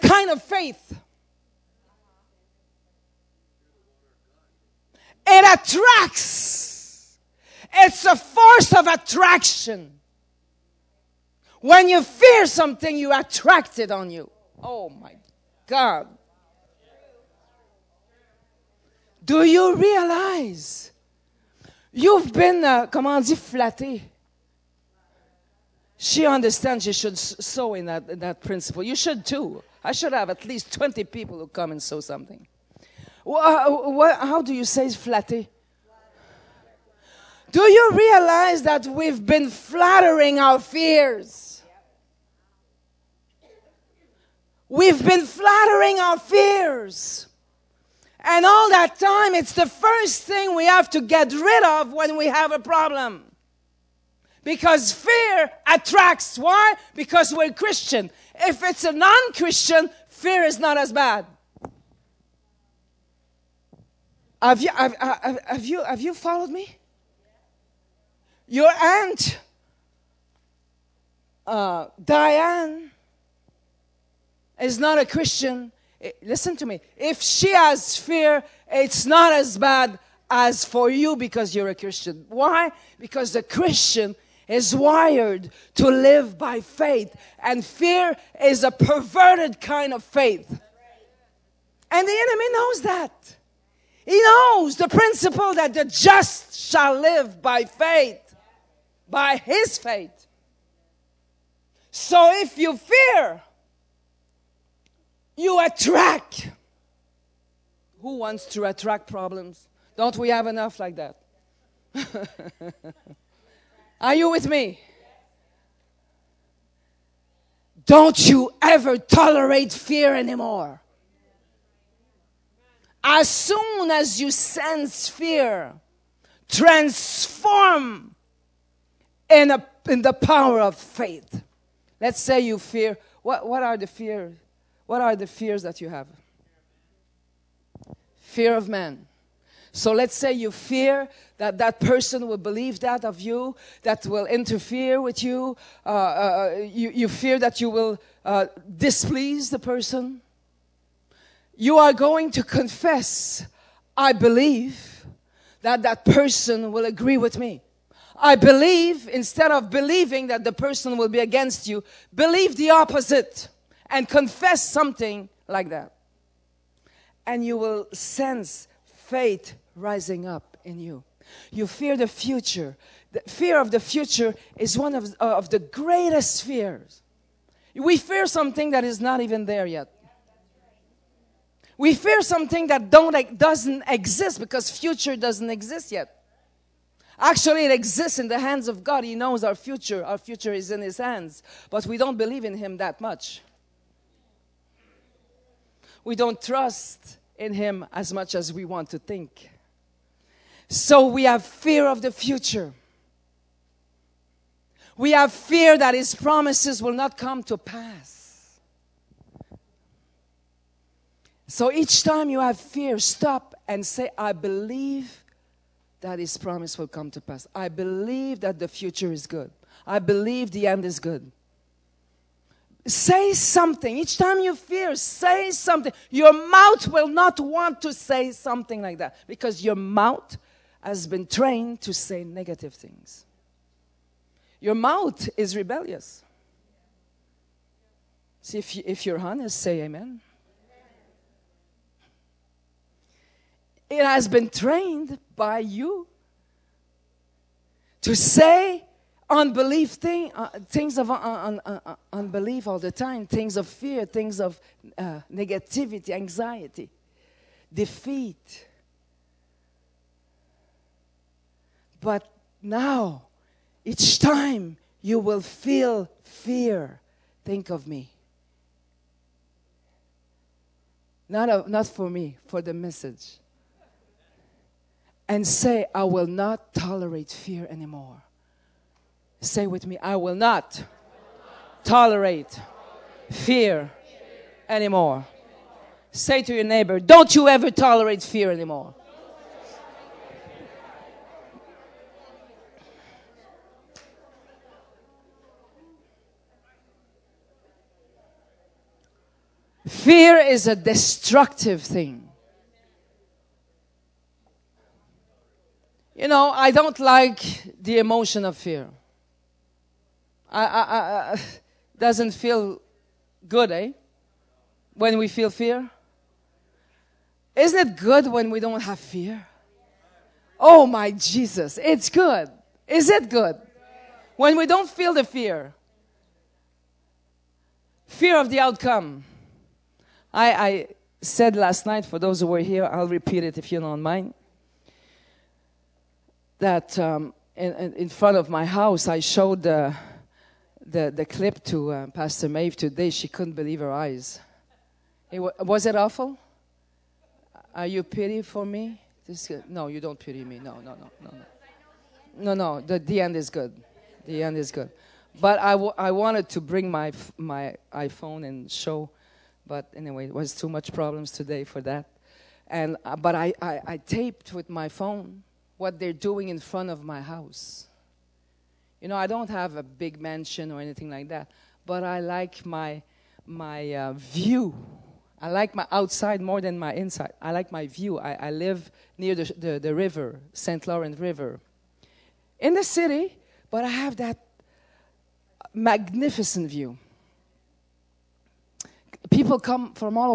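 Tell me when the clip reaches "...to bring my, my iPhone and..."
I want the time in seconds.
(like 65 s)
356 s.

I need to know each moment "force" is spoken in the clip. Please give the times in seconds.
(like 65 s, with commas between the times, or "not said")
8 s.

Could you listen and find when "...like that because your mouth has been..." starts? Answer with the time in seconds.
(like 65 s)
228 s.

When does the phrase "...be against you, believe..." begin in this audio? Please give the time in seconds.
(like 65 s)
161 s.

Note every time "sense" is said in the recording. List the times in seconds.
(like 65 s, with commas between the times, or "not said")
124 s, 167 s.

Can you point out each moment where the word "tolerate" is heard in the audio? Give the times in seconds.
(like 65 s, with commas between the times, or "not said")
118 s, 276 s, 281 s, 287 s.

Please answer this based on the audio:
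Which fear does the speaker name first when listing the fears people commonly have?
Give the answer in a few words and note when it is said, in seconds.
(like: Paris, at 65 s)
Fear of man, at 138 s.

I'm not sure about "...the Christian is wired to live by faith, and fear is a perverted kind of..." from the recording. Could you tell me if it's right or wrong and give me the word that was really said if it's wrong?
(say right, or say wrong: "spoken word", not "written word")
right.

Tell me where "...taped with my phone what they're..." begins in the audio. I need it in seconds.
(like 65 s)
363 s.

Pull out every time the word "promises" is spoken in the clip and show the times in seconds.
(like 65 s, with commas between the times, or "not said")
206 s, 216 s.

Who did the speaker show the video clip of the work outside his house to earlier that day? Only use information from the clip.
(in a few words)
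Pastor Mave.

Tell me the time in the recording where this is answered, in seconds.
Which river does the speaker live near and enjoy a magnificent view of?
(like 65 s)
380 s.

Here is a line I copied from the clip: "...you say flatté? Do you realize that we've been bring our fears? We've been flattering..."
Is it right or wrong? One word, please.
wrong.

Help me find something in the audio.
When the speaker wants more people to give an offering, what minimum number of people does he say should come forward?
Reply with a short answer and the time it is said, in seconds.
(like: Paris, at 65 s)
20, at 30 s.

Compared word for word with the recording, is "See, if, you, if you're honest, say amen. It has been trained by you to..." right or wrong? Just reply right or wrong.
right.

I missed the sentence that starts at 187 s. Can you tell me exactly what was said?
Actually, it exists in the hands of God.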